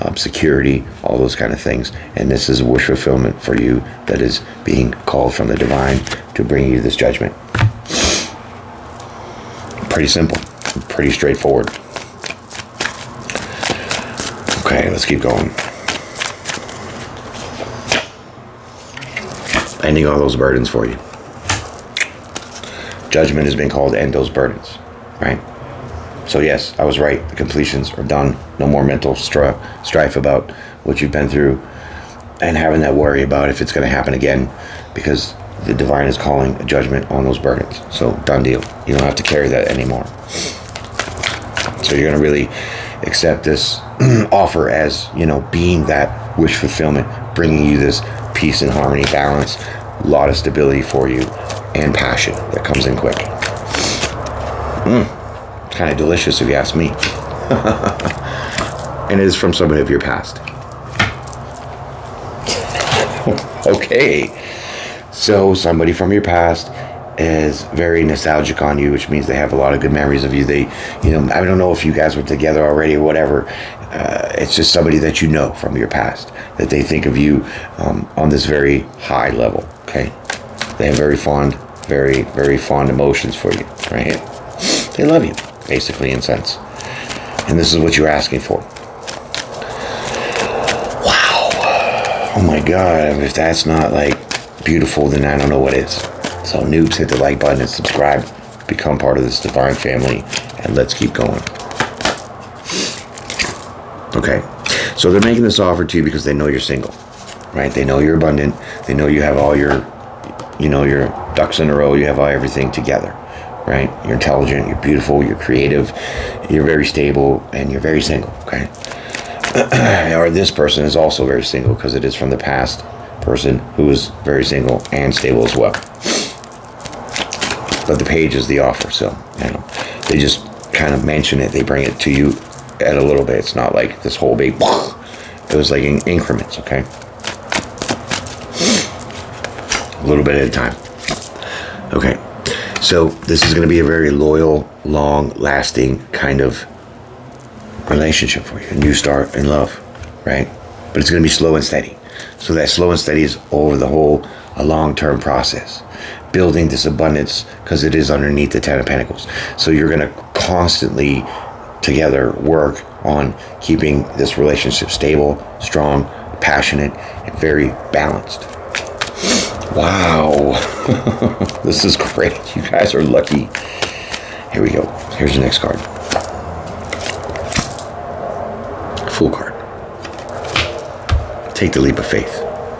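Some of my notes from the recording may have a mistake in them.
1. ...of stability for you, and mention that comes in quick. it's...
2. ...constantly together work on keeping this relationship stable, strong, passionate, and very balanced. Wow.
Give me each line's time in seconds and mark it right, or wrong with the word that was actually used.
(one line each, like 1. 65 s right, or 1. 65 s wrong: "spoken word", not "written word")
1. 50 s wrong: "passion", not "mention"
2. 160 s right.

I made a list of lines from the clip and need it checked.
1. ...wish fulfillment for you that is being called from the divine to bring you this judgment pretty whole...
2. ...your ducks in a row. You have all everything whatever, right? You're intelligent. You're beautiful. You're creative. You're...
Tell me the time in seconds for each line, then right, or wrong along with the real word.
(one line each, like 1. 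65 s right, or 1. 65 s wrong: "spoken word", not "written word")
1. 2 s wrong: "simple", not "whole"
2. 110 s wrong: "together", not "whatever".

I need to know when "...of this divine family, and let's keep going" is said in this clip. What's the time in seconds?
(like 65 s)
99 s.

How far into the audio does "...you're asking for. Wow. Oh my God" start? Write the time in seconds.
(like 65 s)
87 s.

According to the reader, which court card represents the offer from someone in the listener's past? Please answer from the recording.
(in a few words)
The page.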